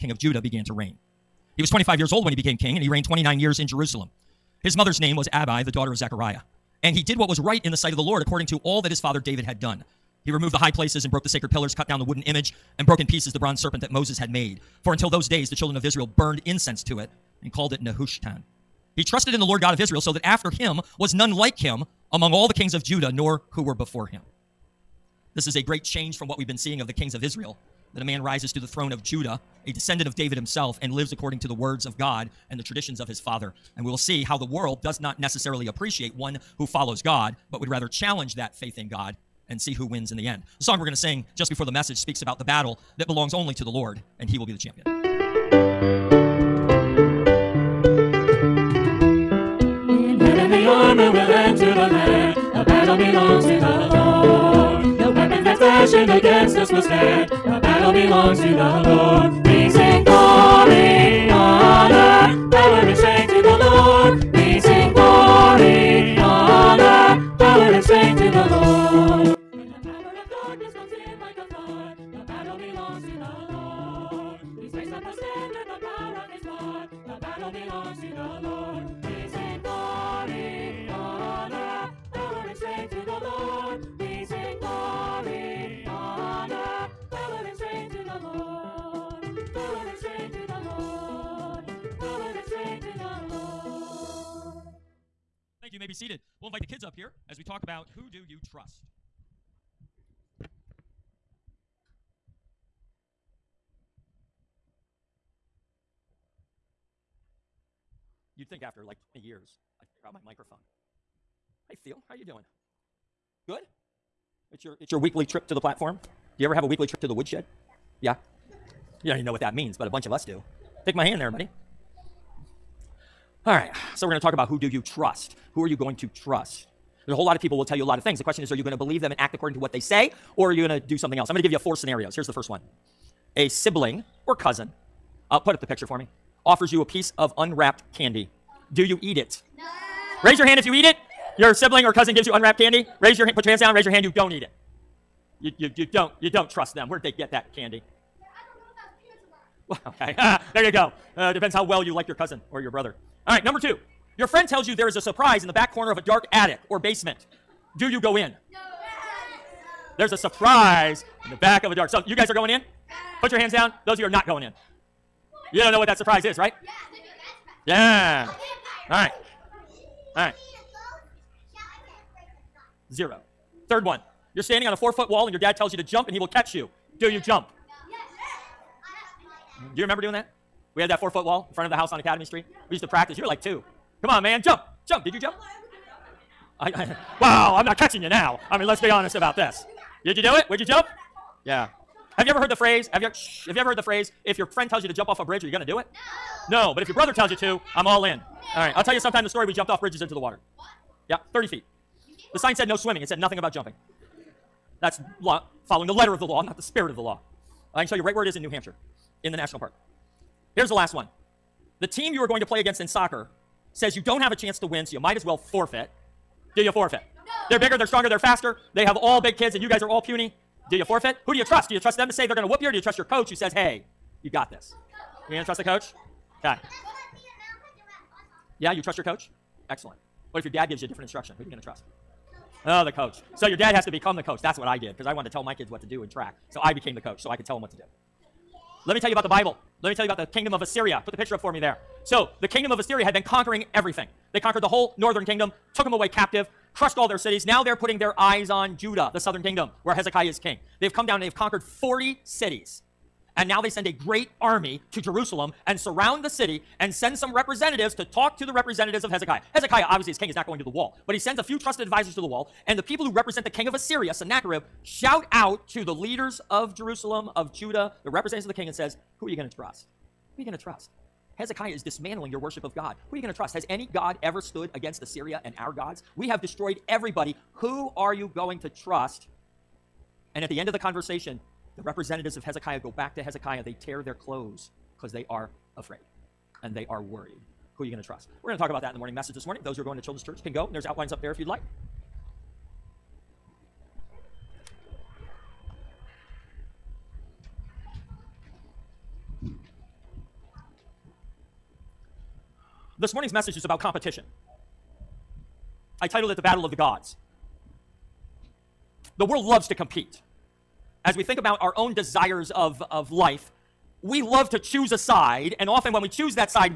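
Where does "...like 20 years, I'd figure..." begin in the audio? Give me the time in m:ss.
1:48.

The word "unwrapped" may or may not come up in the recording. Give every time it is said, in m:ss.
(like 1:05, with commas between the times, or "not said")
2:17, 2:22.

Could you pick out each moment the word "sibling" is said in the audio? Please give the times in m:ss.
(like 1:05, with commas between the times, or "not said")
2:13, 2:21.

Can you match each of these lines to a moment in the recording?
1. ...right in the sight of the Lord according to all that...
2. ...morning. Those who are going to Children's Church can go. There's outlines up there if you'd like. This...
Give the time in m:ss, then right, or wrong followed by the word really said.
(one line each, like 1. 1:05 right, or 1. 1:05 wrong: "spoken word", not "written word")
1. 0:07 right
2. 4:49 right.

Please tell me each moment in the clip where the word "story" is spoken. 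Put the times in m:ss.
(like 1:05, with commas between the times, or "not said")
3:19.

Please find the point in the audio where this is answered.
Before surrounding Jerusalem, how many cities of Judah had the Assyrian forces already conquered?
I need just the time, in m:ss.
4:11.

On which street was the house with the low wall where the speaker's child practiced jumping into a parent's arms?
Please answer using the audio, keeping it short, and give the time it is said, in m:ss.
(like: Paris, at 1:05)
Academy Street, at 3:01.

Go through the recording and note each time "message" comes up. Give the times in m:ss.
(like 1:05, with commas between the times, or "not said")
0:41, 4:49, 5:03.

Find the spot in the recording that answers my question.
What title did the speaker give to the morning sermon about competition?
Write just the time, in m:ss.
5:06.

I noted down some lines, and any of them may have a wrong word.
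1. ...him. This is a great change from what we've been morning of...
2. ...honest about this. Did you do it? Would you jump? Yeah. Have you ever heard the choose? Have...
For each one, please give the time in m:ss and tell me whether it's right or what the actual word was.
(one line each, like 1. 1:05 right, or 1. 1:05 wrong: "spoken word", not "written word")
1. 0:24 wrong: "seeing", not "morning"
2. 3:08 wrong: "phrase", not "choose".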